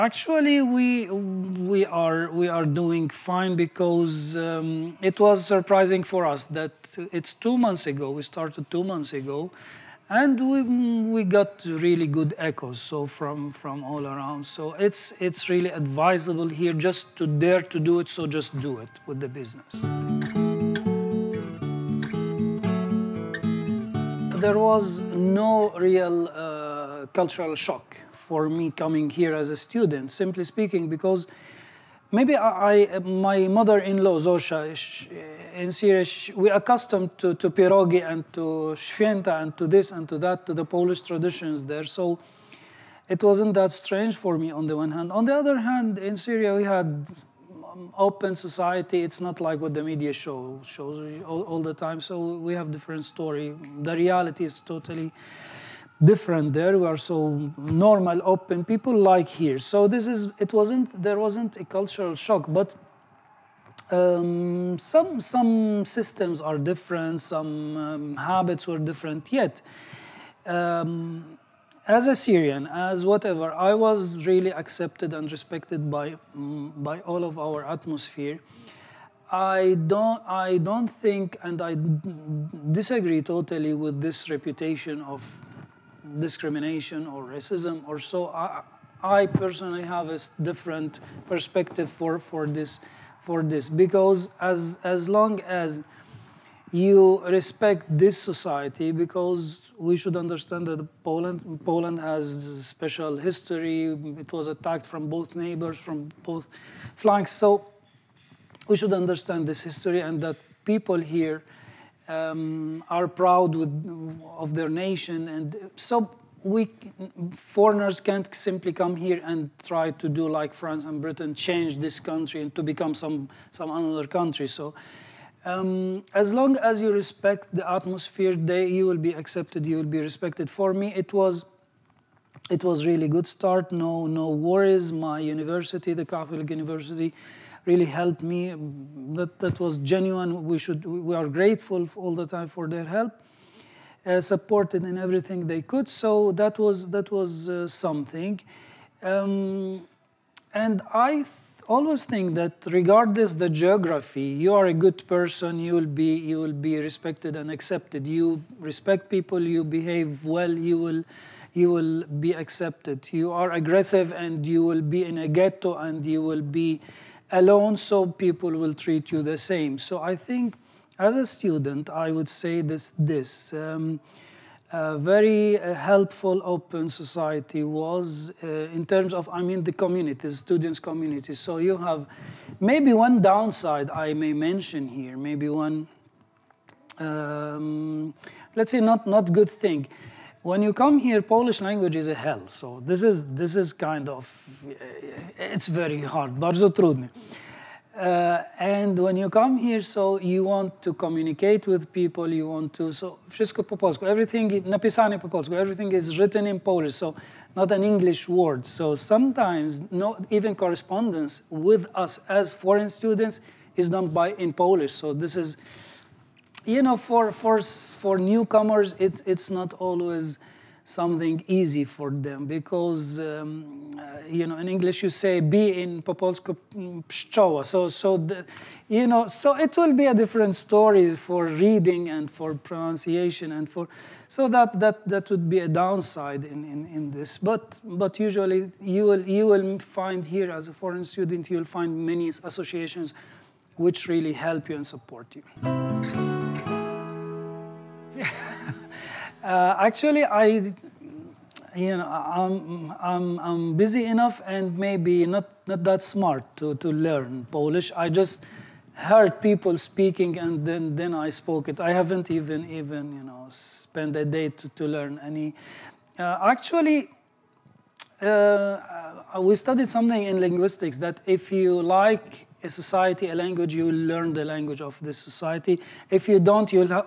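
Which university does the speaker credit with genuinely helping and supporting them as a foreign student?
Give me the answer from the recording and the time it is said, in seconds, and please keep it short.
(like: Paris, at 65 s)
The Catholic University, at 135 s.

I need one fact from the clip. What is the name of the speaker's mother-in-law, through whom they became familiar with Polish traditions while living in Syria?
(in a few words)
Zosia.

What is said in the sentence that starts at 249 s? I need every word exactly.
Uh, actually, I, you know, I'm, I'm, I'm busy enough and maybe not, not that smart to, to learn Polish.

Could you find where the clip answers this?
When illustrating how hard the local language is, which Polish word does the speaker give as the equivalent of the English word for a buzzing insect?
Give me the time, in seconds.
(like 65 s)
227 s.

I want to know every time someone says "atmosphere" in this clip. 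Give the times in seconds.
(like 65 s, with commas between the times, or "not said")
77 s, 127 s.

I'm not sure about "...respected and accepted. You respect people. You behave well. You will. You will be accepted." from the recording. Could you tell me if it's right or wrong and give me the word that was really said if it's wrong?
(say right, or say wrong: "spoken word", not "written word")
right.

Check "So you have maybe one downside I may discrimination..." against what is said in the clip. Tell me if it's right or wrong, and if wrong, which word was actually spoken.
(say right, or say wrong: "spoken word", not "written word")
wrong: "mention", not "discrimination".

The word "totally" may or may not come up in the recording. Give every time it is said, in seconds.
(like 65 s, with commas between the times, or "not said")
54 s, 83 s.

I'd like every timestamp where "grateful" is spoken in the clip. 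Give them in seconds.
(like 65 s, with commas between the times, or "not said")
141 s.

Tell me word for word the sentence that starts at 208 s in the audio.
So sometimes, no, even correspondence with us as foreign students is done by in Polish.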